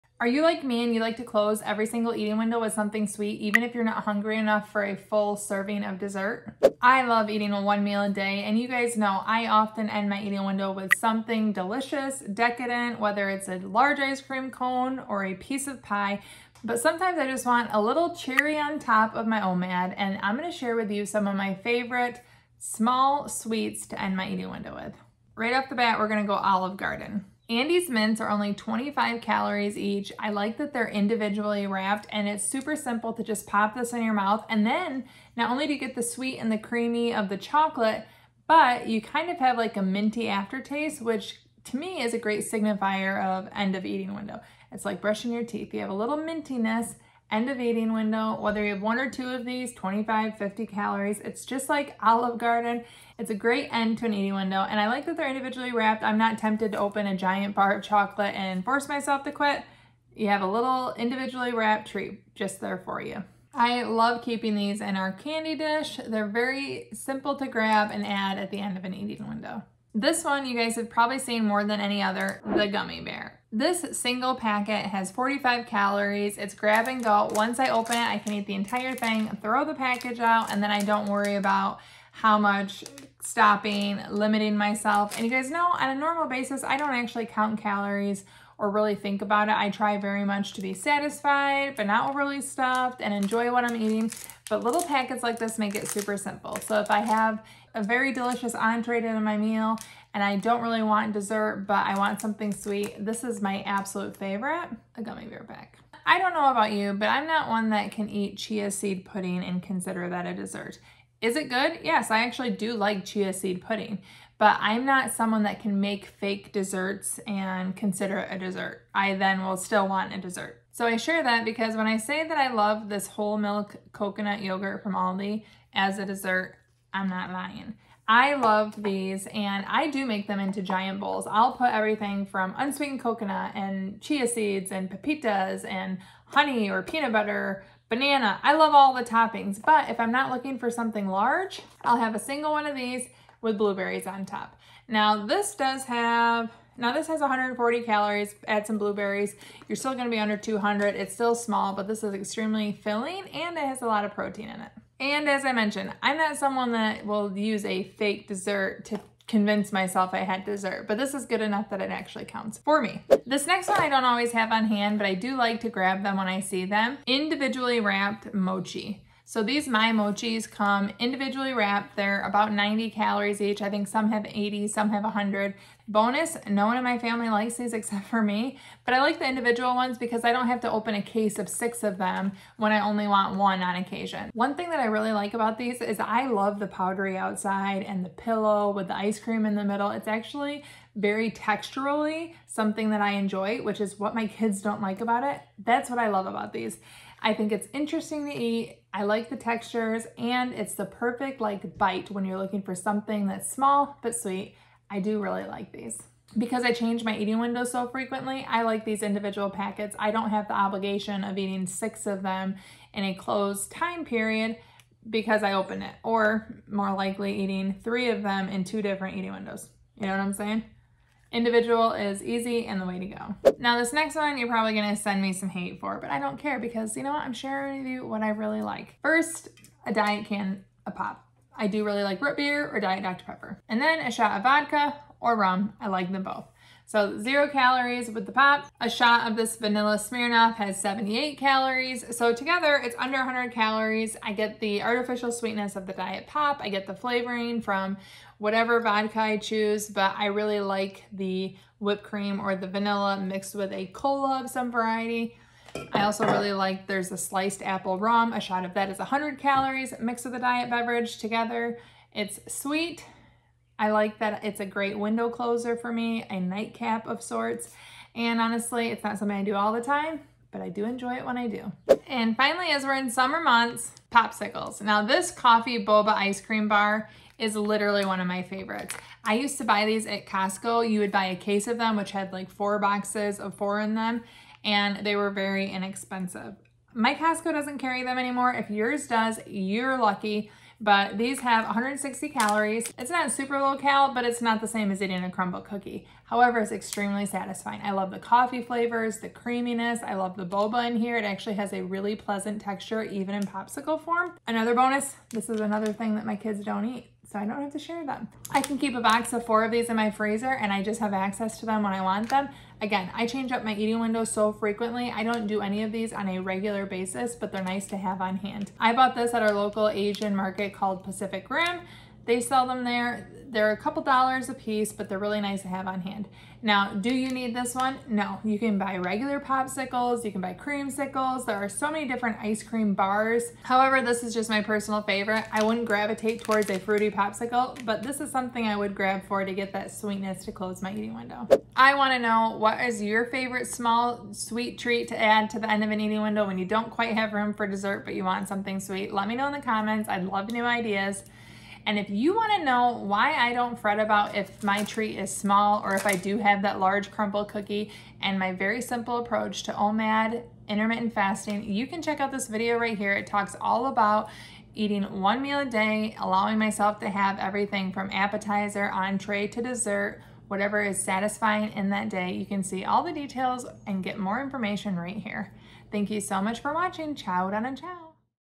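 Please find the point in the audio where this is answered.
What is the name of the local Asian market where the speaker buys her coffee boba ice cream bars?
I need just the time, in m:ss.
5:21.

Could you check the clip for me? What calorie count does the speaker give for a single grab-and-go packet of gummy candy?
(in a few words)
45.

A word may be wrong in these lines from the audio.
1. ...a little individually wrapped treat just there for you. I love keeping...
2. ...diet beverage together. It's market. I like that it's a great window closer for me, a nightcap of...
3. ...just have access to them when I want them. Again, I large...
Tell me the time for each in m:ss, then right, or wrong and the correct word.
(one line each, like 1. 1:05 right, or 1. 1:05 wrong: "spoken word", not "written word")
1. 1:00 right
2. 4:20 wrong: "sweet", not "market"
3. 5:10 wrong: "change", not "large".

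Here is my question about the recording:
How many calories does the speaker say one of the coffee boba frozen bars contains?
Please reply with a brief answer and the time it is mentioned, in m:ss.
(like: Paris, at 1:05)
160, at 4:51.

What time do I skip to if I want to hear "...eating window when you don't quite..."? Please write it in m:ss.
5:45.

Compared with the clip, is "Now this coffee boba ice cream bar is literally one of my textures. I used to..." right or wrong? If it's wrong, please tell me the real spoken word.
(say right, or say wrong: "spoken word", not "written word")
wrong: "favorites", not "textures".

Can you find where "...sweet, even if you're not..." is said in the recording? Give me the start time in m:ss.
0:03.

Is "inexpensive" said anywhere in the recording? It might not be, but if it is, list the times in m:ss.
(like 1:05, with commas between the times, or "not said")
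4:45.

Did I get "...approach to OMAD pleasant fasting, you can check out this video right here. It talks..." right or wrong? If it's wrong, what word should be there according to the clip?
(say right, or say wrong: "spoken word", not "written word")
wrong: "intermittent", not "pleasant".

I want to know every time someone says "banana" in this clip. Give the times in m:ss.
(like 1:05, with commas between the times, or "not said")
2:17.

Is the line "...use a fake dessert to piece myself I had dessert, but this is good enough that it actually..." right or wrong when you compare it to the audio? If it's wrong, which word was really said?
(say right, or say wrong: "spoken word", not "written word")
wrong: "convince", not "piece".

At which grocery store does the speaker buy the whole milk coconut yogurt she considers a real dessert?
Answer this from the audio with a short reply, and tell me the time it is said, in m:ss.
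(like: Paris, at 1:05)
Aldi, at 2:04.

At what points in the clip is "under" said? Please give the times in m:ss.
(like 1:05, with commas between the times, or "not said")
2:30, 4:02.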